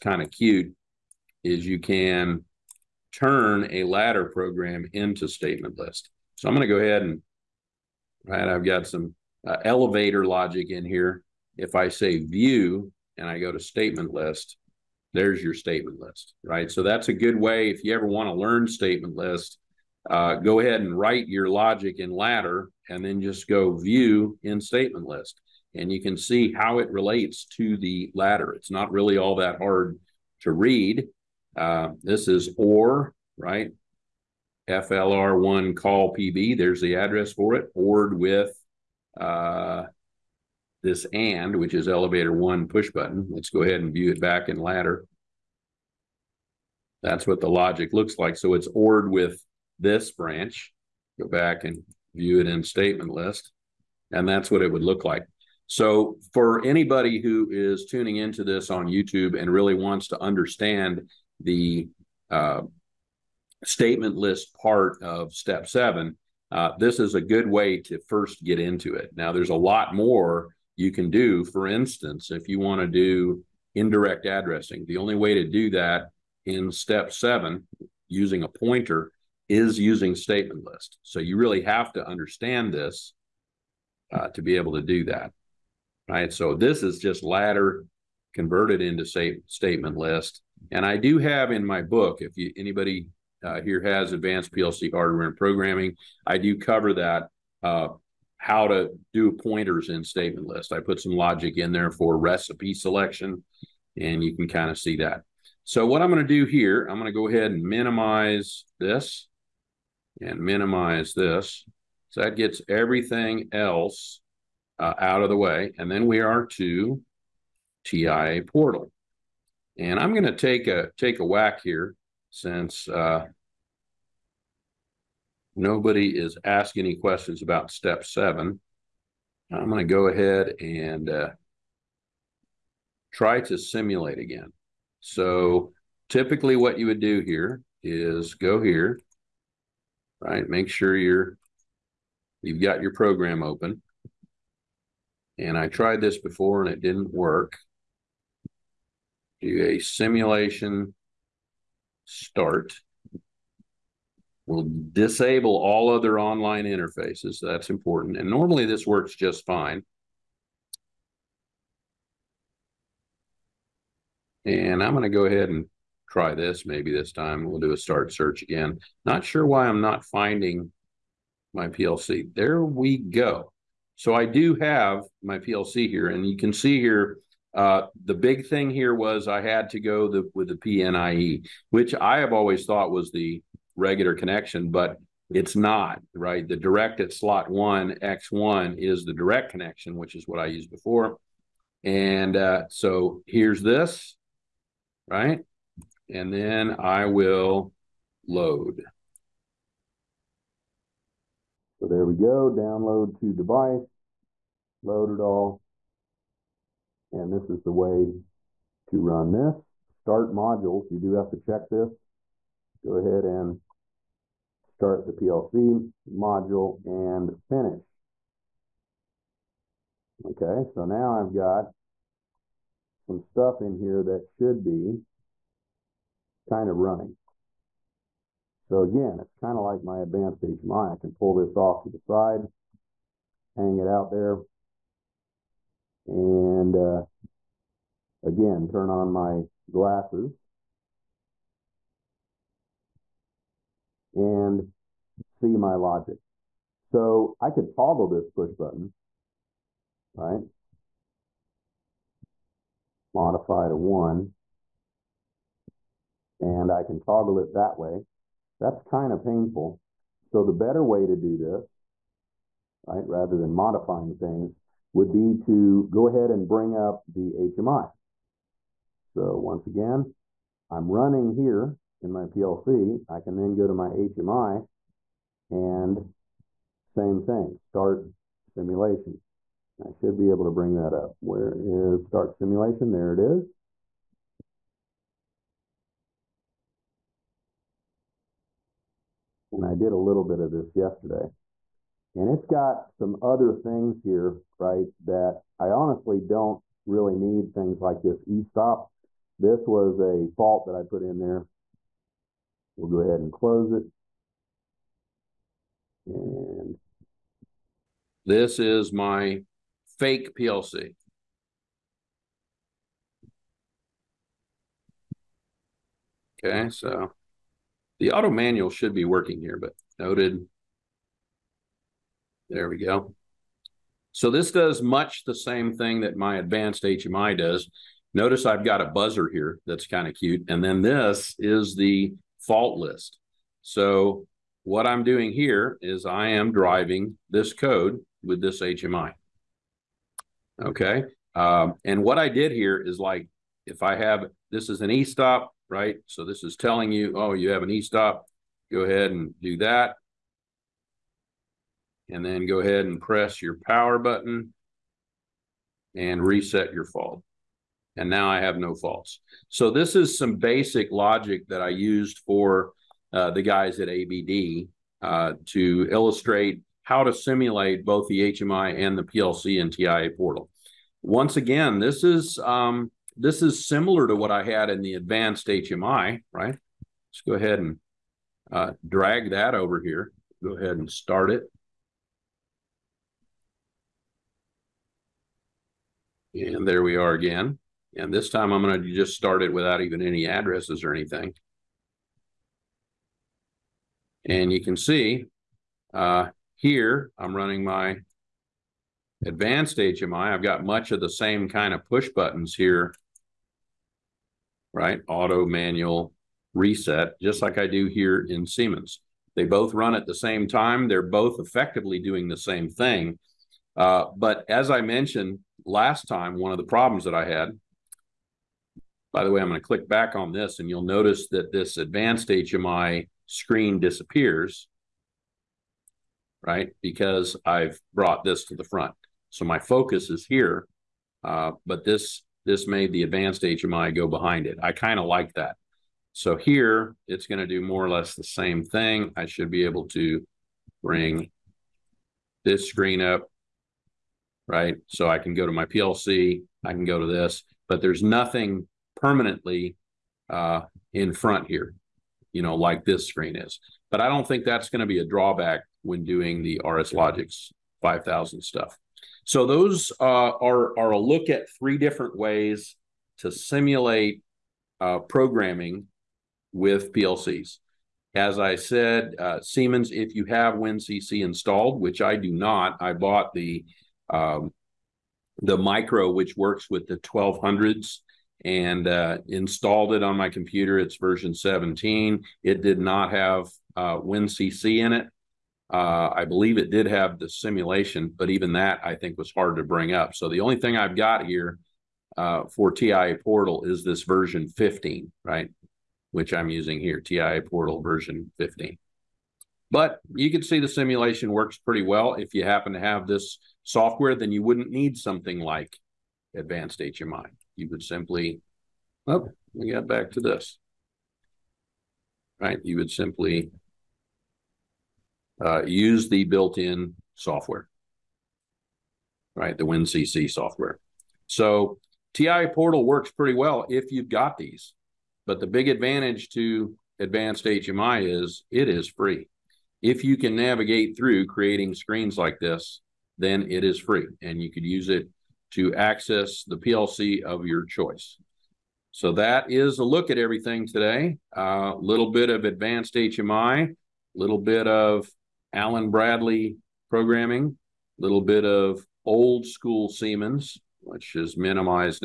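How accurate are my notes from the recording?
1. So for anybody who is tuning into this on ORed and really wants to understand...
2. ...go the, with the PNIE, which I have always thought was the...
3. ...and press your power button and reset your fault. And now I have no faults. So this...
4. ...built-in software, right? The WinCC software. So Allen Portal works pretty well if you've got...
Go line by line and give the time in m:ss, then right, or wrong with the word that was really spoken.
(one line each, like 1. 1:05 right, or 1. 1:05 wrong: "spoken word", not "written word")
1. 0:55 wrong: "YouTube", not "ORed"
2. 2:59 right
3. 5:52 right
4. 8:36 wrong: "TIA", not "Allen".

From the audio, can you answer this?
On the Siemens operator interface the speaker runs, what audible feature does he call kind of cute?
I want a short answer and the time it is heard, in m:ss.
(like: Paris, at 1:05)
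a buzzer, at 5:28.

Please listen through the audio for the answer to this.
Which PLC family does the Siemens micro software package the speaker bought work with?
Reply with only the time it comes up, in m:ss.
7:56.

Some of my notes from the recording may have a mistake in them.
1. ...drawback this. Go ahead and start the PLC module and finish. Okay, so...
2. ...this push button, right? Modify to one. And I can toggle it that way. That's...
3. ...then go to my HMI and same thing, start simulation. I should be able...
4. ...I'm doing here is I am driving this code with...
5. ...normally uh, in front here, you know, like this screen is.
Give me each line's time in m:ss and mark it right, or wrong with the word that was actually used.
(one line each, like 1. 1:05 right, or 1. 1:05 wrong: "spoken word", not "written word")
1. 3:31 wrong: "check", not "drawback"
2. 4:08 right
3. 4:33 right
4. 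5:34 right
5. 7:28 wrong: "permanently", not "normally".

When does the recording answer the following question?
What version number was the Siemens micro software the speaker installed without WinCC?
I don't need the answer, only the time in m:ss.
8:00.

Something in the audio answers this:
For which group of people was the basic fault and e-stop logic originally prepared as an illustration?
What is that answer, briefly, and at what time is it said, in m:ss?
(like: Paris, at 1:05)
ABD, at 6:03.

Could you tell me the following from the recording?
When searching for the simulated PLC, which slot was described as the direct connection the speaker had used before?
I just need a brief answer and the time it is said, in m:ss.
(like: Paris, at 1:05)
X1, at 3:08.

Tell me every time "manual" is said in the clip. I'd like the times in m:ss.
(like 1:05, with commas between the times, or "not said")
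5:18, 6:45.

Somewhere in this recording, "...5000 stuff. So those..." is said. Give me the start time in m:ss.
7:37.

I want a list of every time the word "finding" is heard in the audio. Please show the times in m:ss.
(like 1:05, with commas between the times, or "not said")
2:50.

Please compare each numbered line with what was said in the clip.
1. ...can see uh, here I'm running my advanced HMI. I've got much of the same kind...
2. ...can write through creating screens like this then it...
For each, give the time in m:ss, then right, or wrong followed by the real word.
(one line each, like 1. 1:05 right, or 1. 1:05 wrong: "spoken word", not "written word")
1. 6:34 right
2. 8:50 wrong: "navigate", not "write".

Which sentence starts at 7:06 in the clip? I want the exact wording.
Because I've brought this to the front.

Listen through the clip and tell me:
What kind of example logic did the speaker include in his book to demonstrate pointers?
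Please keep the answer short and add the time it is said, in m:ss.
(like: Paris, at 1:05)
recipe selection, at 1:42.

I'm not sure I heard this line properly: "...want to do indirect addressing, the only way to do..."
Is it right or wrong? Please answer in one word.
right.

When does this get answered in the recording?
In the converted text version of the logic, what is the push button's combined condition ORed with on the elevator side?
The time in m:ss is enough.
0:41.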